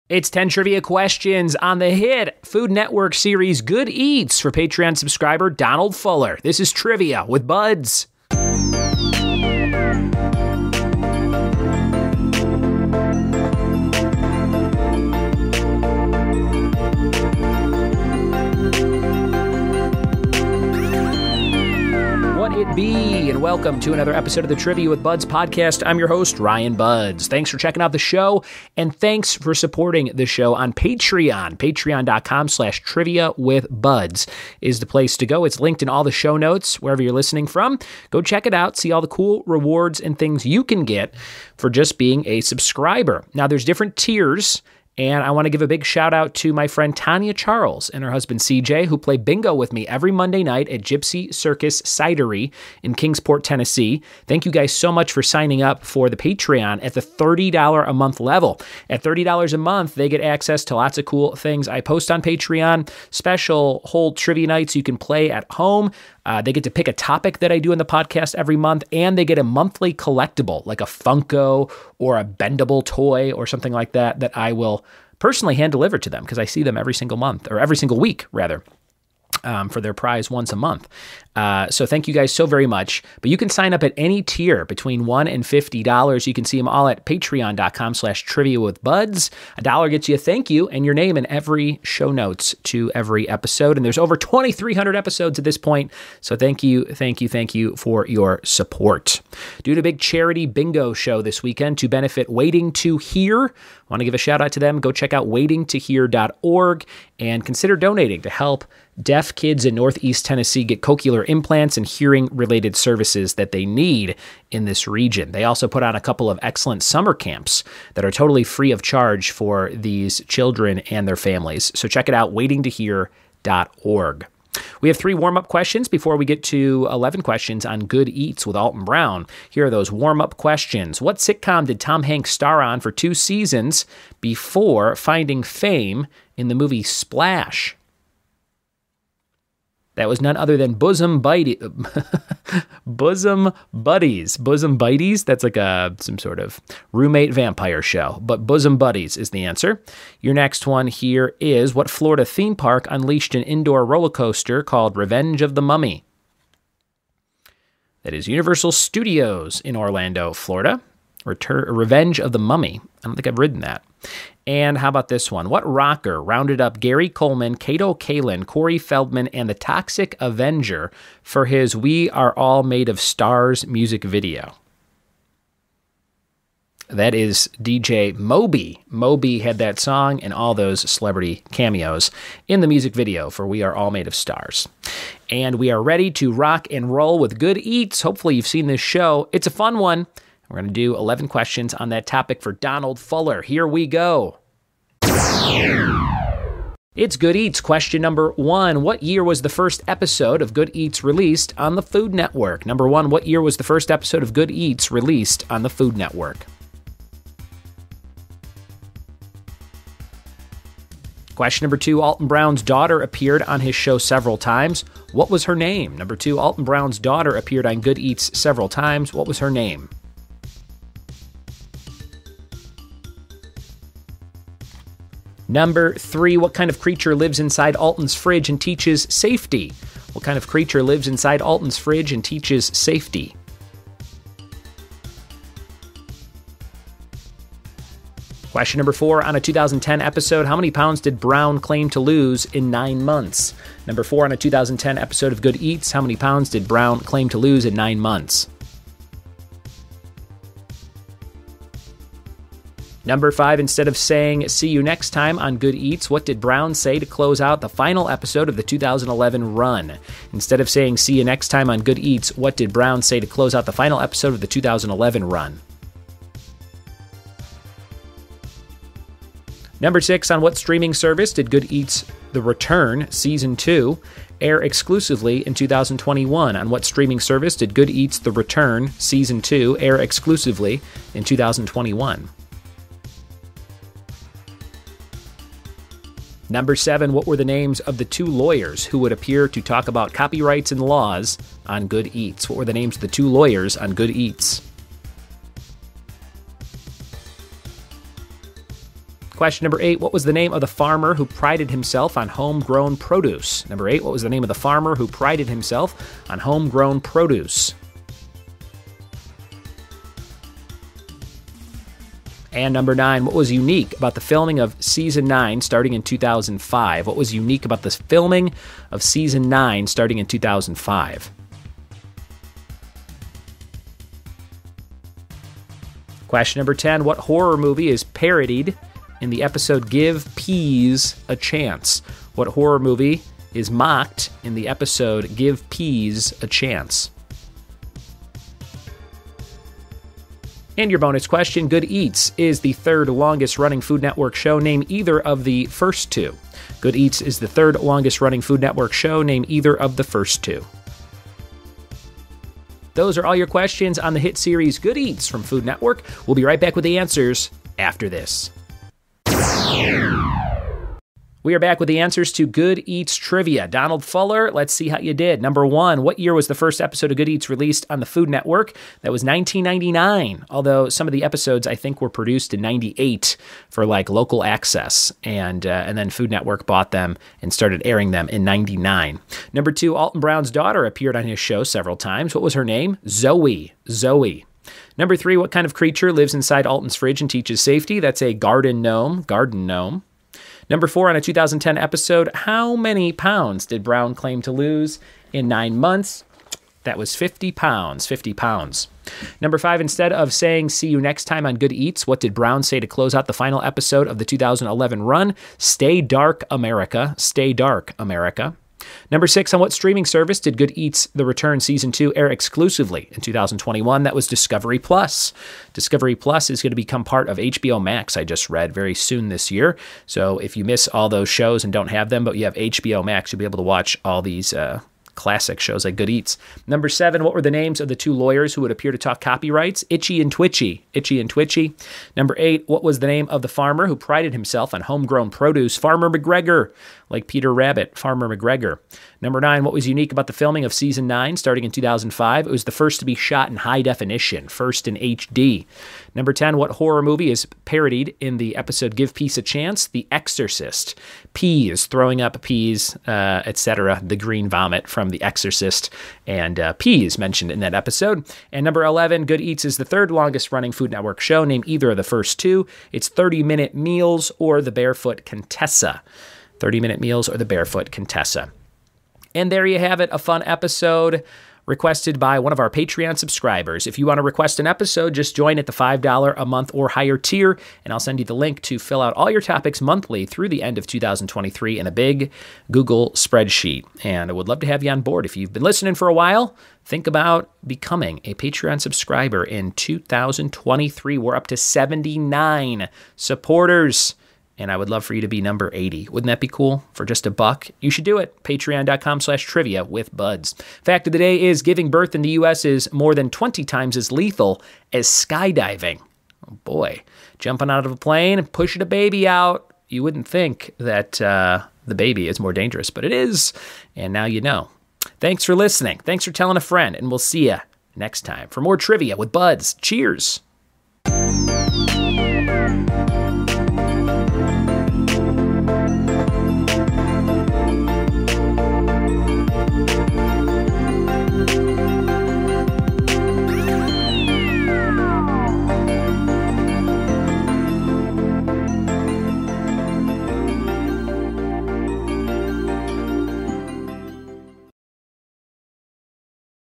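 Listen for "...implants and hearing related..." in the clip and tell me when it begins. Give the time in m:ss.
1:51.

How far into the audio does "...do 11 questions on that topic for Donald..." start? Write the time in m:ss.
3:10.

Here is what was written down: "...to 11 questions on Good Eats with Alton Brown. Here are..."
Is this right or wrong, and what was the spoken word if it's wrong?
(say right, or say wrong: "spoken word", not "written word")
right.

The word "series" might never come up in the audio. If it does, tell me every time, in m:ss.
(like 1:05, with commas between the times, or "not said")
0:03, 5:54.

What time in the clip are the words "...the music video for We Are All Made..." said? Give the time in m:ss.
3:02.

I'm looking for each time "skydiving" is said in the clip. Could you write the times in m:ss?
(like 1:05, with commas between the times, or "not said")
8:25.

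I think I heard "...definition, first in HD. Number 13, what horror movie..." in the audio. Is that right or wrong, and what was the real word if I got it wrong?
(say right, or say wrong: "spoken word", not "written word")
wrong: "10", not "13".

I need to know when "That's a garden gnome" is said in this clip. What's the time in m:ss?
6:27.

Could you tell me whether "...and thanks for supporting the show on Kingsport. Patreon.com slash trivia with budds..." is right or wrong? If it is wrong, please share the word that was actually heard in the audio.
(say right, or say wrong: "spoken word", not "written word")
wrong: "Patreon", not "Kingsport".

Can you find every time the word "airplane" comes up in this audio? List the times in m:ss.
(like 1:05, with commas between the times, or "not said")
not said.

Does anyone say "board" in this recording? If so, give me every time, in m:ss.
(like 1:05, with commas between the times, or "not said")
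8:05.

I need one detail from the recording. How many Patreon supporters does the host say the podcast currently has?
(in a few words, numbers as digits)
79.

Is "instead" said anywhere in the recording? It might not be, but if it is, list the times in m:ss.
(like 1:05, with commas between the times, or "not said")
4:13, 4:20, 6:39.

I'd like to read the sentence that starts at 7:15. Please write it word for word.
Farmer McGregor like Peter Rabbit, Farmer McGregor.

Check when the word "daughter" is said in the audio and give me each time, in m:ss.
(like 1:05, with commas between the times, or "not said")
3:32, 3:36, 6:20.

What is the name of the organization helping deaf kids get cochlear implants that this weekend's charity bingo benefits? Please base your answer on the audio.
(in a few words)
Waiting to Hear.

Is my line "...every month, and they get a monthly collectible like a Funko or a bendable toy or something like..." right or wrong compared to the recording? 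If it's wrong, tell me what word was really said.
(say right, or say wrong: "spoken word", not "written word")
right.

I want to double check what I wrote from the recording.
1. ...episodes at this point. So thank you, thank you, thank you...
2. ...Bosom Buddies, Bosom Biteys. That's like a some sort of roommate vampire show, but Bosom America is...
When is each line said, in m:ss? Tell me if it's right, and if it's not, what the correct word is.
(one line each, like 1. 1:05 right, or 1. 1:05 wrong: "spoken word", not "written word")
1. 1:34 right
2. 2:22 wrong: "Buddies", not "America".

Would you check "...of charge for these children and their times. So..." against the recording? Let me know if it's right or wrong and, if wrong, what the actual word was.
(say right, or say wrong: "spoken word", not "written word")
wrong: "families", not "times".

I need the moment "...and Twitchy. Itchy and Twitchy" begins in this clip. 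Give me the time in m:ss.
7:10.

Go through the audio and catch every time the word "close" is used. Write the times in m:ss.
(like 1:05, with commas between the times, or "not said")
4:17, 4:23, 6:42.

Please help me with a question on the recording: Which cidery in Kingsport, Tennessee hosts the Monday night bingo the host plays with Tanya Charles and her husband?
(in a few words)
Gypsy Circus Cidery.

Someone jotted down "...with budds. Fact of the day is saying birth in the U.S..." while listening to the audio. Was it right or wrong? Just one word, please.
wrong.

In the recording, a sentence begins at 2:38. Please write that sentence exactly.
That is Universal Studios in Orlando, Florida.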